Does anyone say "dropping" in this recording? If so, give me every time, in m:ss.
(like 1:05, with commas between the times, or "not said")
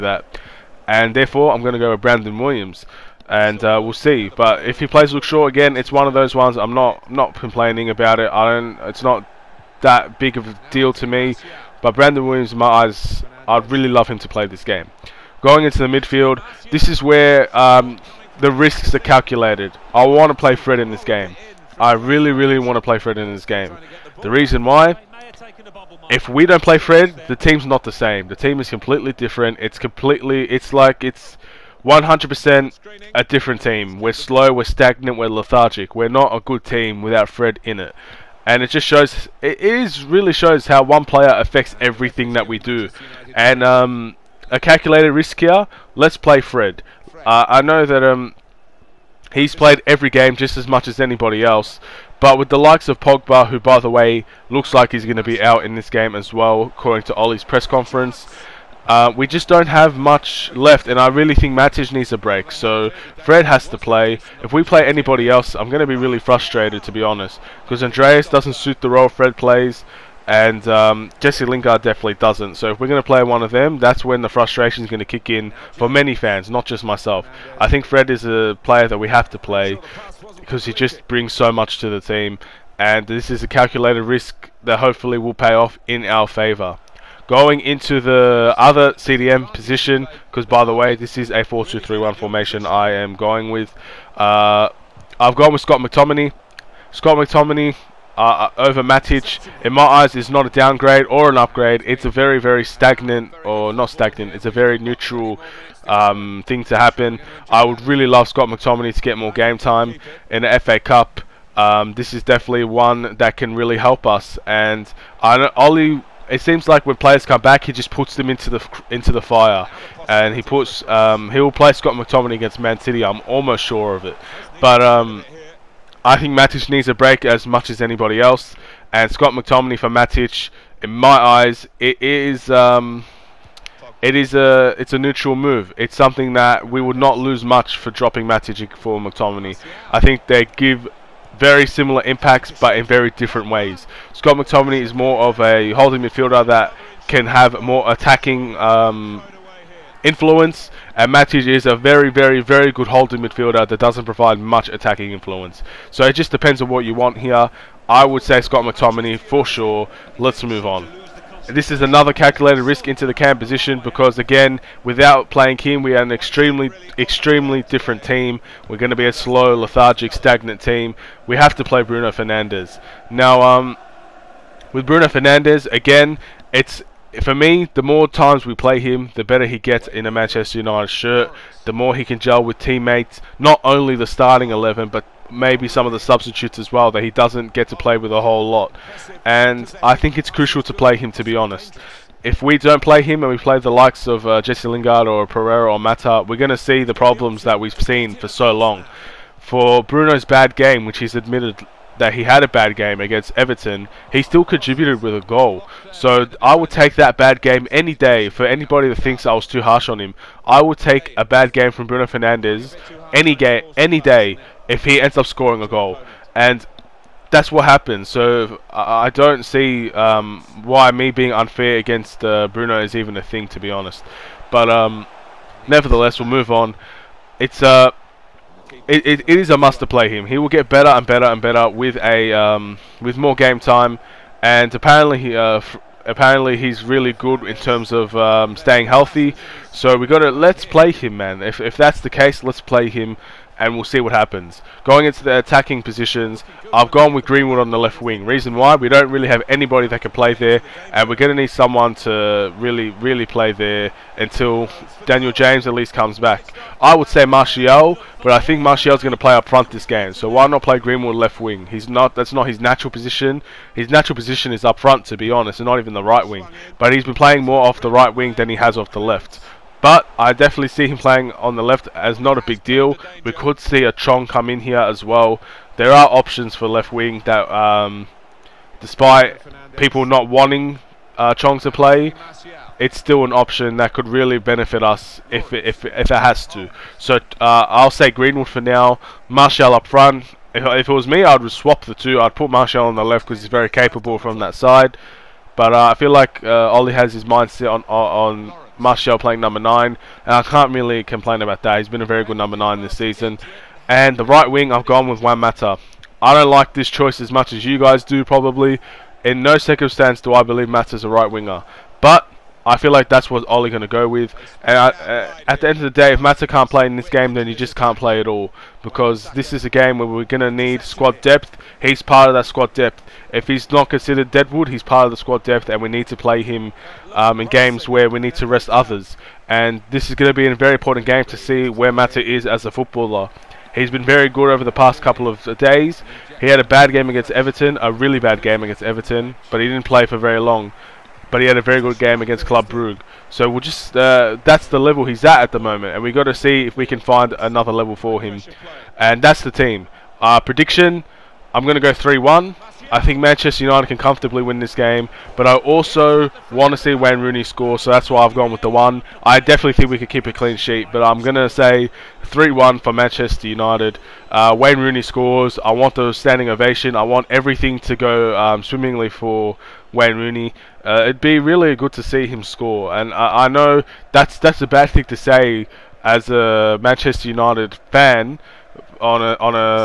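2:17.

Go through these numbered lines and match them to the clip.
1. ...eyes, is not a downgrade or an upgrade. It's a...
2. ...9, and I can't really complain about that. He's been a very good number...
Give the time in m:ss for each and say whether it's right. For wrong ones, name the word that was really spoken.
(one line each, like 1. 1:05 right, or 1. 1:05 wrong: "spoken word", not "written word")
1. 1:39 right
2. 4:59 right.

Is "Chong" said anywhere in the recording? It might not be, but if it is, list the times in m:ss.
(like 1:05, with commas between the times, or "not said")
4:33, 4:41.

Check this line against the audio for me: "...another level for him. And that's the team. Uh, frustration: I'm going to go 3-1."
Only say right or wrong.
wrong.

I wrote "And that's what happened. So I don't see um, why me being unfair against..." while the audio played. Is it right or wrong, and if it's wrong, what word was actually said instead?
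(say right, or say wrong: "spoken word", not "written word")
right.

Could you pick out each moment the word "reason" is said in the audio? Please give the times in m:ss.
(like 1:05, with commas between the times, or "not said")
0:24, 4:08.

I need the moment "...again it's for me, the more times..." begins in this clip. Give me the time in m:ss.
2:55.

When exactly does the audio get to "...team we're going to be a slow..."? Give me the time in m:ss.
2:48.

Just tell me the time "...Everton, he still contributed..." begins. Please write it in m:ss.
3:23.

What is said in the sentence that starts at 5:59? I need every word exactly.
I definitely think we could keep a clean sheet, but I'm going to say 3-1 for Manchester United.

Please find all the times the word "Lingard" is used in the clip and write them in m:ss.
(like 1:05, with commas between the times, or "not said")
1:11, 3:14.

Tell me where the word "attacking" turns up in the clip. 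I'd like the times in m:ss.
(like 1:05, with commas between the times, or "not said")
2:27, 2:34, 4:05.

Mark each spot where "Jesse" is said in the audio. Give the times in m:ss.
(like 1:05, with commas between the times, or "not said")
1:11, 3:14.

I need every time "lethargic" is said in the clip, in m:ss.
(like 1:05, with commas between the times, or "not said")
0:35, 2:49.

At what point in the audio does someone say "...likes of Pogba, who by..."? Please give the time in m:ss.
0:52.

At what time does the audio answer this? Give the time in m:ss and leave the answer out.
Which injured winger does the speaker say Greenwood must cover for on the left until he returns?
4:15.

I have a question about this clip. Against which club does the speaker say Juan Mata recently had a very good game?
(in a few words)
Club Brugge.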